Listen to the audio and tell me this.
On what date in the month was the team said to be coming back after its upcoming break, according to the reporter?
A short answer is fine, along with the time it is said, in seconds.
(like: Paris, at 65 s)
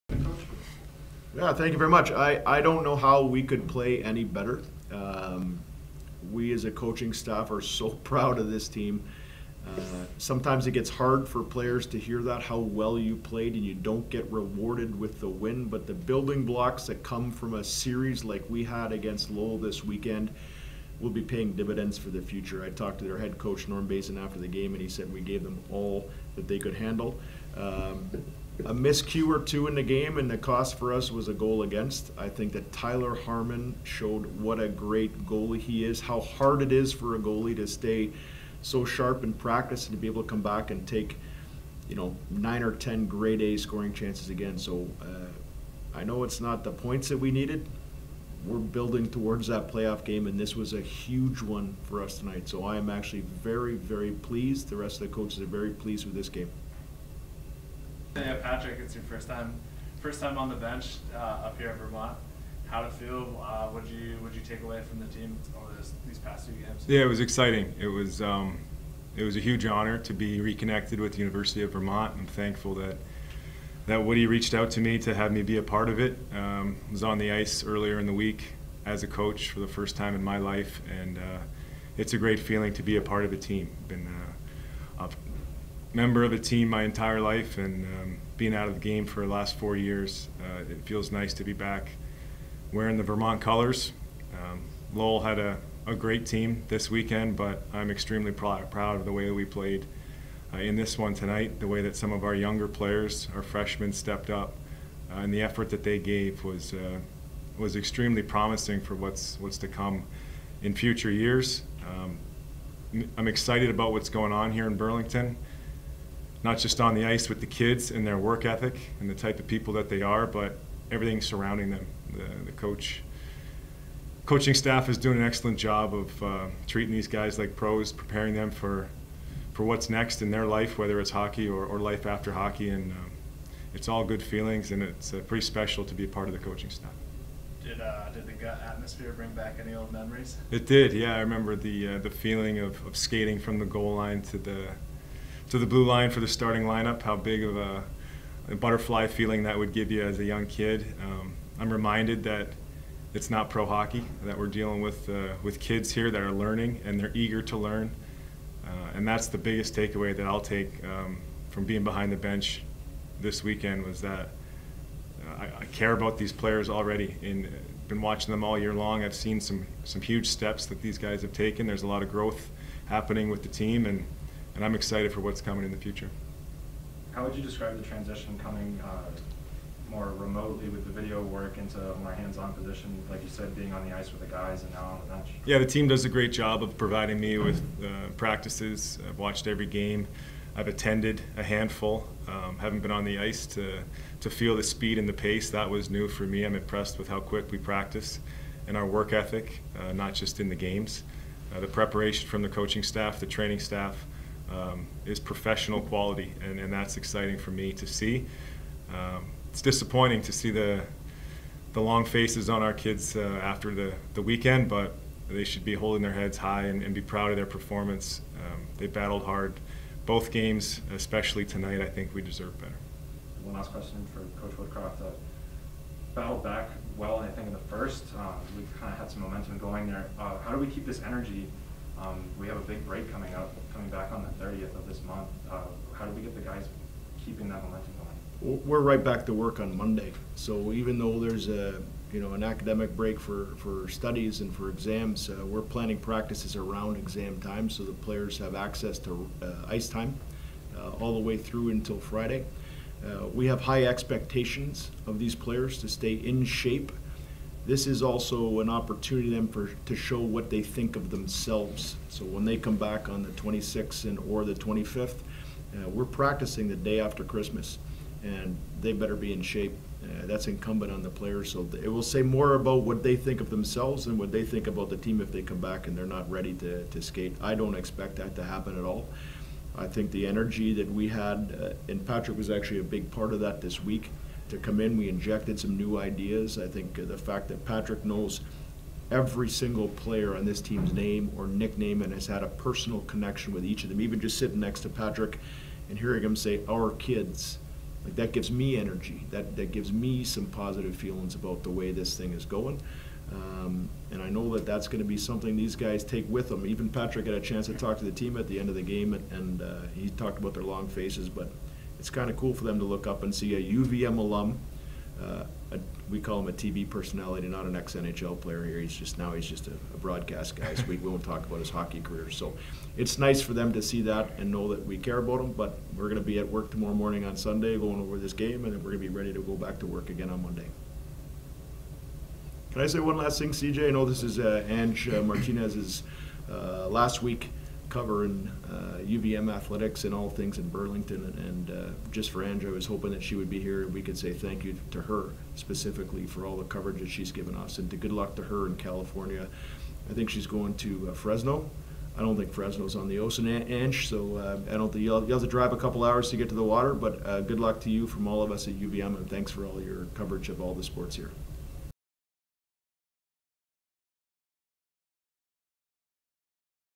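30th, at 234 s.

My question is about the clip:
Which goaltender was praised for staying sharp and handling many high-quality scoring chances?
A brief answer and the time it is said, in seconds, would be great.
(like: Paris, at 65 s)
Tyler Harmon, at 32 s.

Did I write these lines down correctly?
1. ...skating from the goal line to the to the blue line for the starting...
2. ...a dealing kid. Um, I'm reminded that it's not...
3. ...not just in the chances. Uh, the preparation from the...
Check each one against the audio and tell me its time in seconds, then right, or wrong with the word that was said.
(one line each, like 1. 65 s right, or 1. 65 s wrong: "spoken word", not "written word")
1. 142 s right
2. 150 s wrong: "young", not "dealing"
3. 199 s wrong: "games", not "chances".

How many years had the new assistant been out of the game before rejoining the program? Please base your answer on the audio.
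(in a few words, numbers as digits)
4.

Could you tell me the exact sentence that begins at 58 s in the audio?
It's your first time, first time on the bench uh, up here in Vermont.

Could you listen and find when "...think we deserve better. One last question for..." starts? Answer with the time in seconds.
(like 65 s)
221 s.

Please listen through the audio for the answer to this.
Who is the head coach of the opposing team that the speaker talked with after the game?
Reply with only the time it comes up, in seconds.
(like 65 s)
23 s.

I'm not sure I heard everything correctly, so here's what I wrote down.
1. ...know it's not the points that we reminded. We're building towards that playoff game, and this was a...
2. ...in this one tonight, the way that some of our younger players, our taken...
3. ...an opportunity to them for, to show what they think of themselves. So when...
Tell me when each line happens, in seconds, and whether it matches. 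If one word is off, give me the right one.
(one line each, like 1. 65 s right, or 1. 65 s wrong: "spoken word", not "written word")
1. 46 s wrong: "needed", not "reminded"
2. 100 s wrong: "freshmen", not "taken"
3. 258 s right.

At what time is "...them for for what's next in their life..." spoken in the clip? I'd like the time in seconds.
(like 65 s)
128 s.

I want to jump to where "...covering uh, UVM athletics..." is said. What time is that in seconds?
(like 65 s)
337 s.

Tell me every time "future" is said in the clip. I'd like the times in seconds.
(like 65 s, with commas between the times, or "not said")
22 s, 110 s, 175 s.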